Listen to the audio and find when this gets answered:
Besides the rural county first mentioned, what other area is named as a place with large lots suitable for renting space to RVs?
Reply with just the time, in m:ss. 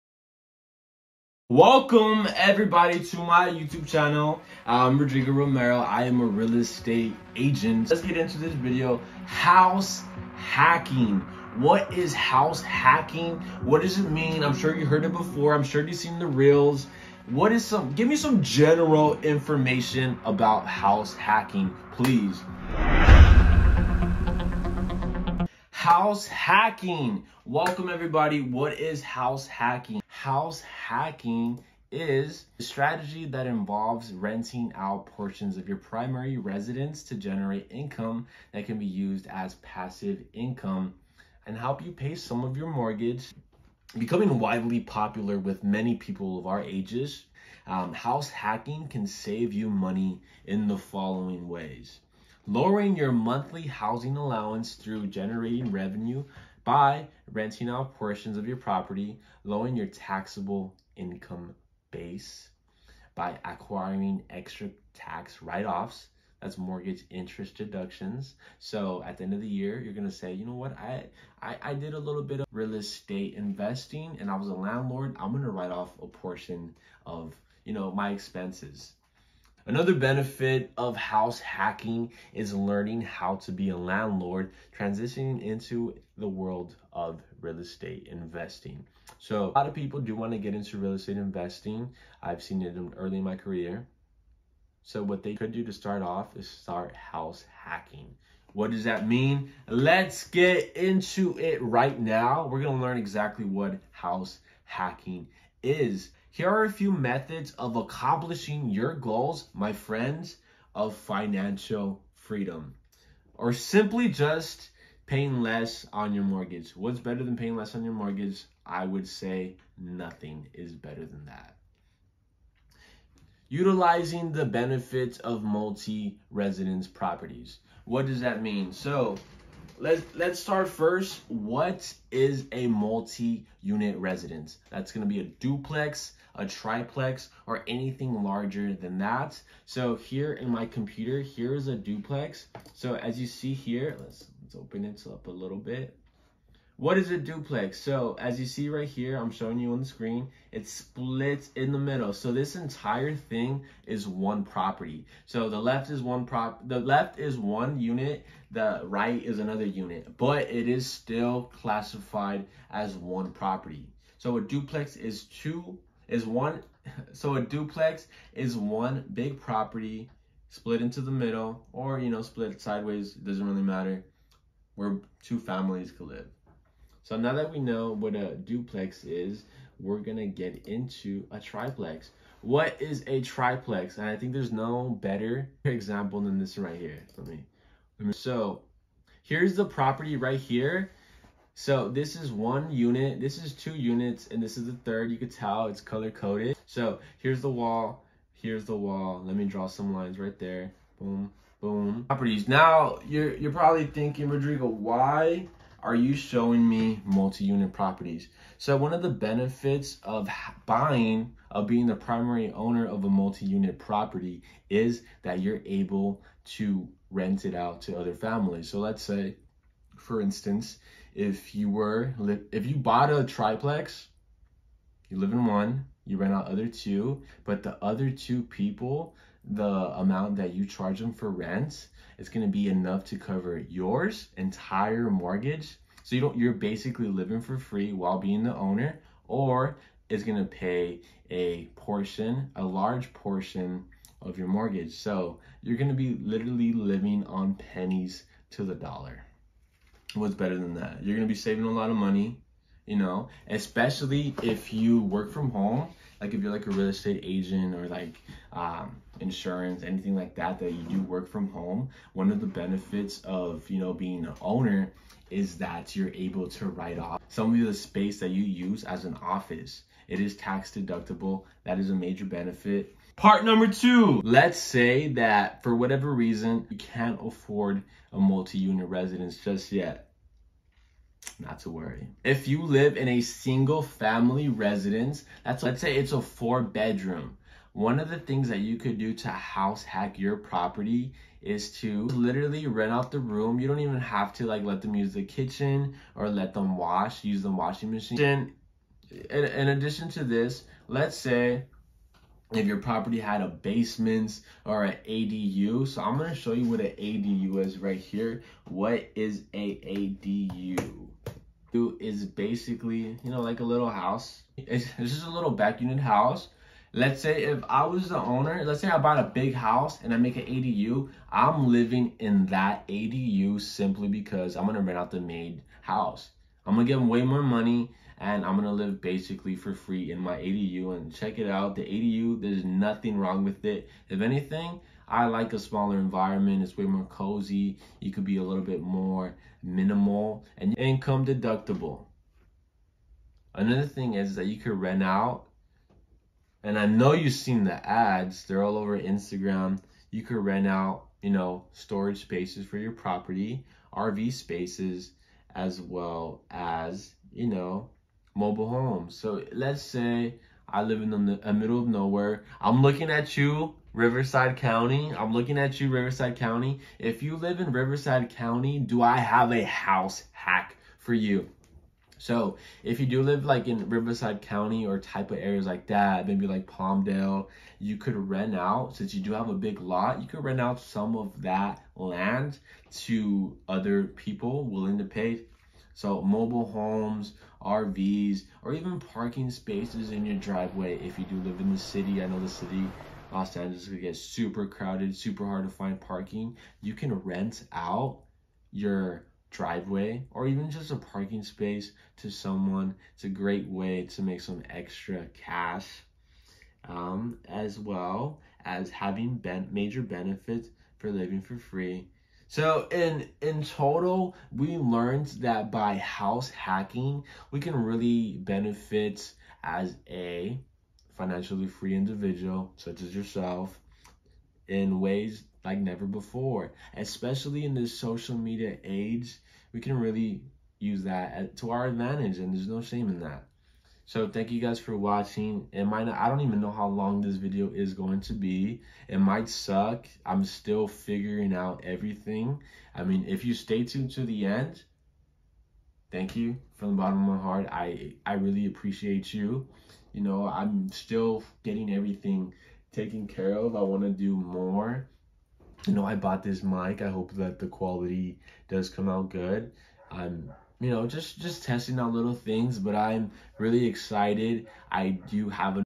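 6:16.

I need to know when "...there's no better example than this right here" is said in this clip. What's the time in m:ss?
3:04.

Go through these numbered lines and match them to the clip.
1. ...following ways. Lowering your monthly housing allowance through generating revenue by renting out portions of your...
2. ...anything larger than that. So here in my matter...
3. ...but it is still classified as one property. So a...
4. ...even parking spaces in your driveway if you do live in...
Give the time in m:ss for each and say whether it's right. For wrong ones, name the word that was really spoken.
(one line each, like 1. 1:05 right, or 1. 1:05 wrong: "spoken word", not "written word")
1. 0:50 right
2. 2:17 wrong: "computer", not "matter"
3. 2:40 right
4. 6:28 right.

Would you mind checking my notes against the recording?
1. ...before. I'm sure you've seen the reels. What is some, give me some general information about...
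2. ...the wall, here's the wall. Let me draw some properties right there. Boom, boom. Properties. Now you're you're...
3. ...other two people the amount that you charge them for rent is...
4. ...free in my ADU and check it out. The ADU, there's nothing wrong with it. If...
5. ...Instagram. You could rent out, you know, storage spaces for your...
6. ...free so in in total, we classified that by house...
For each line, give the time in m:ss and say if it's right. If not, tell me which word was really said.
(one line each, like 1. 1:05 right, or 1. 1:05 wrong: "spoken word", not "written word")
1. 0:15 right
2. 3:17 wrong: "lines", not "properties"
3. 3:47 right
4. 5:29 right
5. 5:48 right
6. 6:51 wrong: "learned", not "classified".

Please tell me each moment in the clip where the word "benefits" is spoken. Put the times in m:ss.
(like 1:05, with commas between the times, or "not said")
1:19, 2:04, 3:29, 4:22, 4:32, 6:50, 6:58.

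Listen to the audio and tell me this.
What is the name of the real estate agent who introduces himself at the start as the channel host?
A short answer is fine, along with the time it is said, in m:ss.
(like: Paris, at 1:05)
Rodrigo Romero, at 0:04.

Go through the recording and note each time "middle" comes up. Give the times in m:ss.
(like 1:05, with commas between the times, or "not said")
2:31, 2:51, 6:01.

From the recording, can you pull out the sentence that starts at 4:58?
In, in addition to this, let's say if mm-hmm.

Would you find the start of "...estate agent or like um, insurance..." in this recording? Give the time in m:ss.
4:16.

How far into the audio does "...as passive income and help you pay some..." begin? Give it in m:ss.
0:39.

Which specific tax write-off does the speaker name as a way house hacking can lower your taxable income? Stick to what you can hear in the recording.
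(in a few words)
Mortgage interest deductions.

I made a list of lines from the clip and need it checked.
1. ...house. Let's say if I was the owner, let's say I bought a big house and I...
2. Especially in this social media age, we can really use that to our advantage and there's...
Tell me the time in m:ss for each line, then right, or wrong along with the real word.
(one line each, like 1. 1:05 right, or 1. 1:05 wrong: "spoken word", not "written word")
1. 5:15 right
2. 7:06 right.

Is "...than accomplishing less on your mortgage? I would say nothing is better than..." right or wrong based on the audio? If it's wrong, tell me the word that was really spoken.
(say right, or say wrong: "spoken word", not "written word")
wrong: "paying", not "accomplishing".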